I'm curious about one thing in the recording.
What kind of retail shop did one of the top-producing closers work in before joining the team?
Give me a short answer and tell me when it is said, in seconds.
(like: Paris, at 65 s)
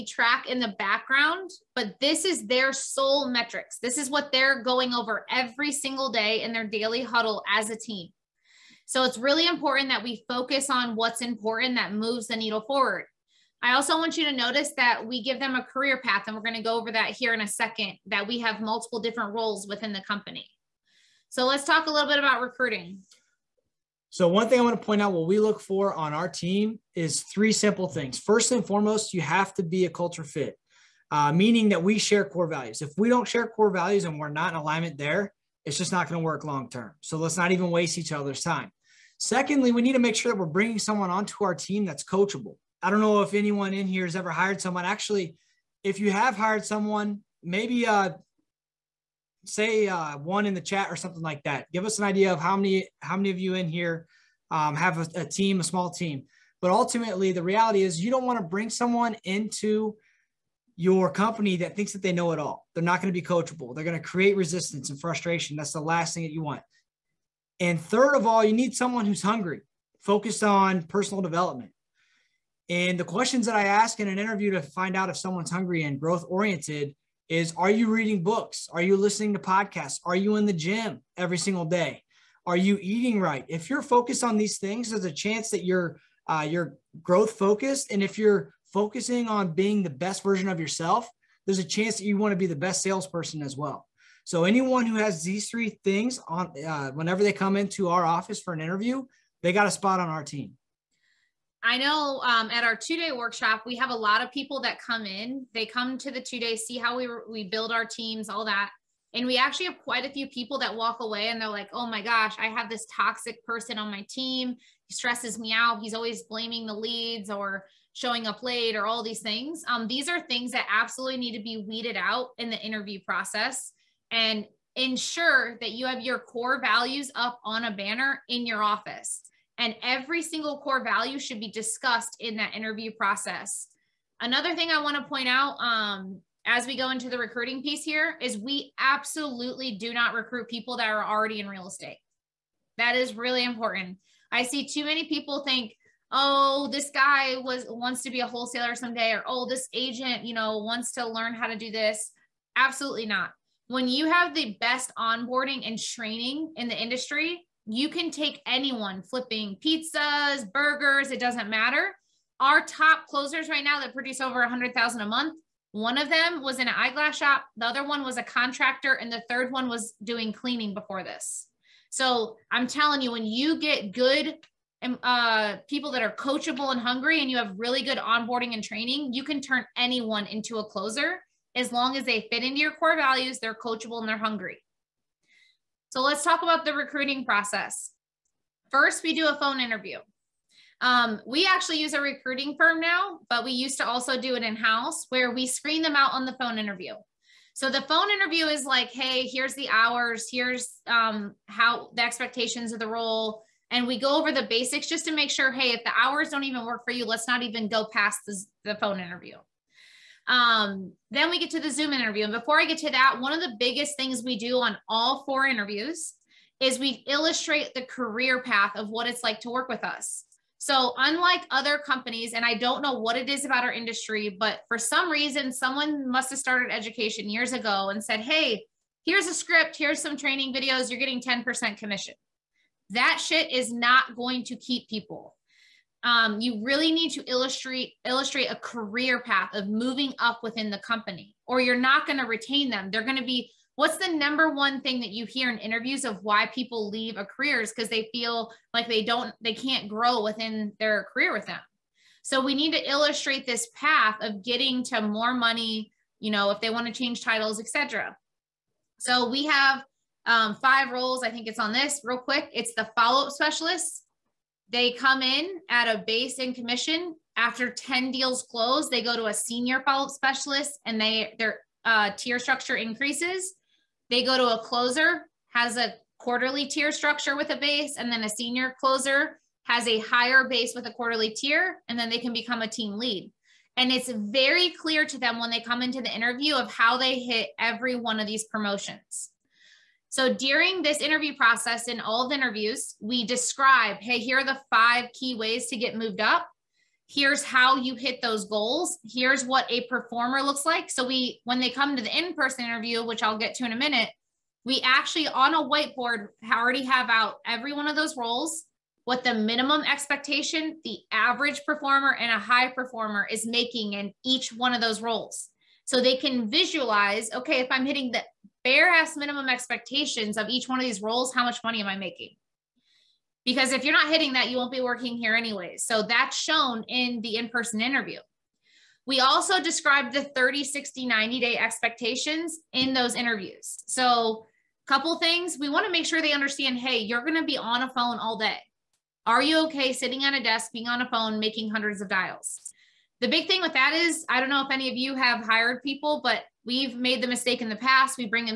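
eyeglass shop, at 166 s.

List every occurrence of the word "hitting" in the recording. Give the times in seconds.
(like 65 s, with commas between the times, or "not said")
317 s, 324 s.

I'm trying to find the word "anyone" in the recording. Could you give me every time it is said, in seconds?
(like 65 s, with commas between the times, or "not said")
43 s, 94 s, 158 s, 179 s.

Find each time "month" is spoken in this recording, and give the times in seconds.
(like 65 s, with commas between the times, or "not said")
165 s.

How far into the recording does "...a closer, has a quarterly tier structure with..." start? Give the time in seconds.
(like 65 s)
274 s.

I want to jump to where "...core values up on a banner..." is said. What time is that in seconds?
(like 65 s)
126 s.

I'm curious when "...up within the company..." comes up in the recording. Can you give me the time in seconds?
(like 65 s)
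240 s.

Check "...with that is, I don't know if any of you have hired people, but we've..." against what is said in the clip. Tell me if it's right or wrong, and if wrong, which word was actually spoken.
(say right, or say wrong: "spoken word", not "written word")
right.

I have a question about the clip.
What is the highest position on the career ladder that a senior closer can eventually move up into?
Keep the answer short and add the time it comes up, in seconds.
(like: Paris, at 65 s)
team lead, at 282 s.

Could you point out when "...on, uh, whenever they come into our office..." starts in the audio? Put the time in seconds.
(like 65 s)
96 s.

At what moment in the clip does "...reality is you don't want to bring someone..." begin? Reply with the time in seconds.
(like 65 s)
57 s.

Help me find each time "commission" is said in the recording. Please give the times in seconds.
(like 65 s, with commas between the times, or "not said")
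231 s, 266 s.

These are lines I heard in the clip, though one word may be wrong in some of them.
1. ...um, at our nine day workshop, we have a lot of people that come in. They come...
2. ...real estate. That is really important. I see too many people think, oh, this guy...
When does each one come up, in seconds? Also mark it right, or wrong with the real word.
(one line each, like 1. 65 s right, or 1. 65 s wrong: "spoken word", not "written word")
1. 102 s wrong: "two", not "nine"
2. 141 s right.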